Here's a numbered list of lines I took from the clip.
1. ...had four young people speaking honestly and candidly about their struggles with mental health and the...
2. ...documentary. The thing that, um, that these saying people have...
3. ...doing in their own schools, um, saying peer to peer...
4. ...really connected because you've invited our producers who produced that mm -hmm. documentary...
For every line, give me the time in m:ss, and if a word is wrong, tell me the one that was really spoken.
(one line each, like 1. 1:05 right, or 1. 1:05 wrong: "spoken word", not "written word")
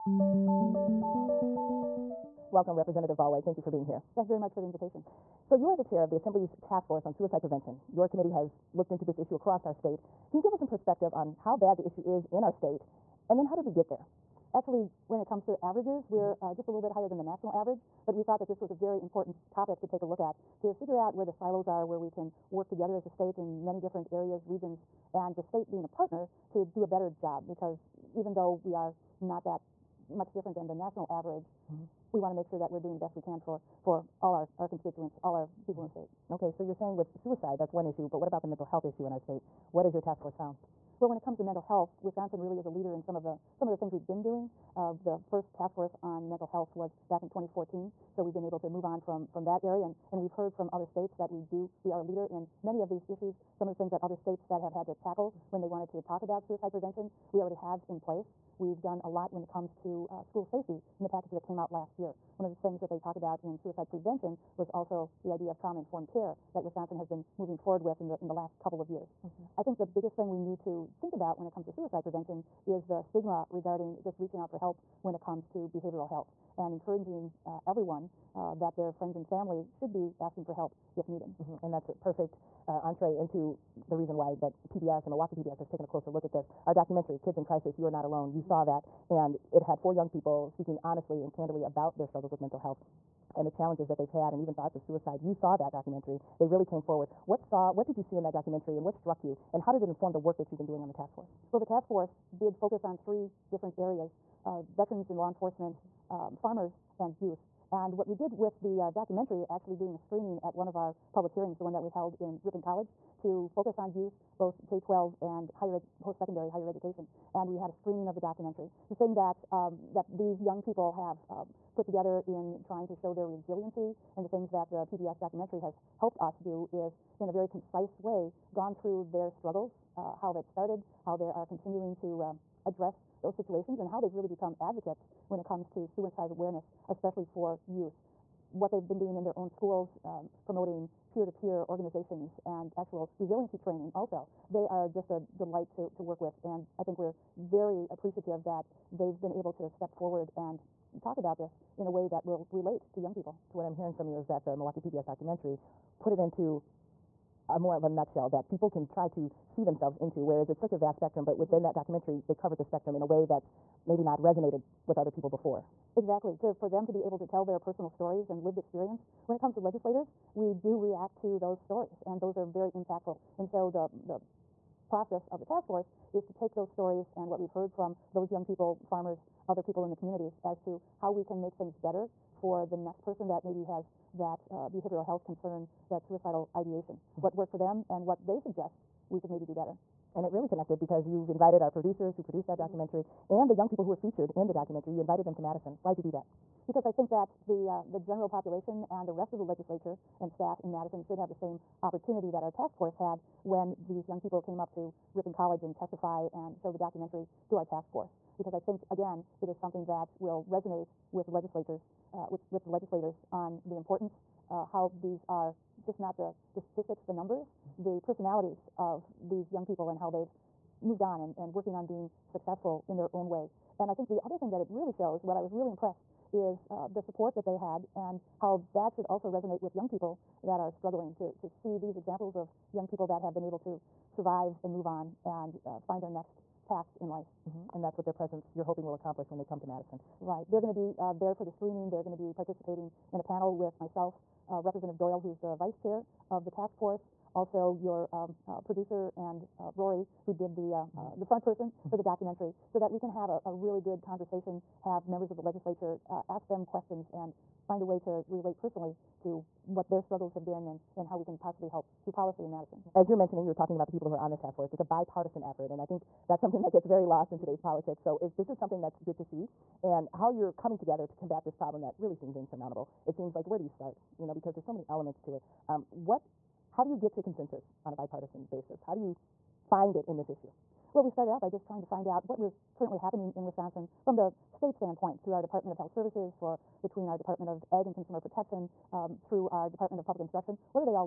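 1. 1:29 right
2. 1:58 wrong: "young", not "saying"
3. 2:18 wrong: "promoting", not "saying"
4. 3:10 right.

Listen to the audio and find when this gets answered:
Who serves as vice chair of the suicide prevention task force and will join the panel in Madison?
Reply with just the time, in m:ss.
4:04.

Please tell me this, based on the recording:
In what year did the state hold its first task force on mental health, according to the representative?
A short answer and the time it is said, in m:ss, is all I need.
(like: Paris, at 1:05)
2014, at 0:47.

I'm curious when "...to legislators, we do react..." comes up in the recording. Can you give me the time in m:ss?
2:49.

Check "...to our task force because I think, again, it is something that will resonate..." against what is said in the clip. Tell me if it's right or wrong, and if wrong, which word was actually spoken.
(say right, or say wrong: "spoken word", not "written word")
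right.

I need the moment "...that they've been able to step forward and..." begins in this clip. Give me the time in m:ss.
2:28.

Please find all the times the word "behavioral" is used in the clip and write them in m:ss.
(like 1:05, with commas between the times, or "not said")
1:15, 3:04.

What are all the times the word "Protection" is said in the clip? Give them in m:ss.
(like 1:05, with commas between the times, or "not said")
4:48.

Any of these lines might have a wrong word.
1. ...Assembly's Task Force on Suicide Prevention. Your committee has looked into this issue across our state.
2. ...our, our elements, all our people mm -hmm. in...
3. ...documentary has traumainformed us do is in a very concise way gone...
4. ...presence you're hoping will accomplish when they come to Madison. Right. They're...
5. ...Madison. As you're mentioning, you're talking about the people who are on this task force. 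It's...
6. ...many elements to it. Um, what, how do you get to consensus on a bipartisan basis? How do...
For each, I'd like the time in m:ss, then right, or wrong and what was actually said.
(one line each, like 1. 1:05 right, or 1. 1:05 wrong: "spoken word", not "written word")
1. 0:06 right
2. 0:34 wrong: "constituents", not "elements"
3. 2:05 wrong: "helped", not "traumainformed"
4. 3:58 right
5. 4:22 right
6. 4:34 right.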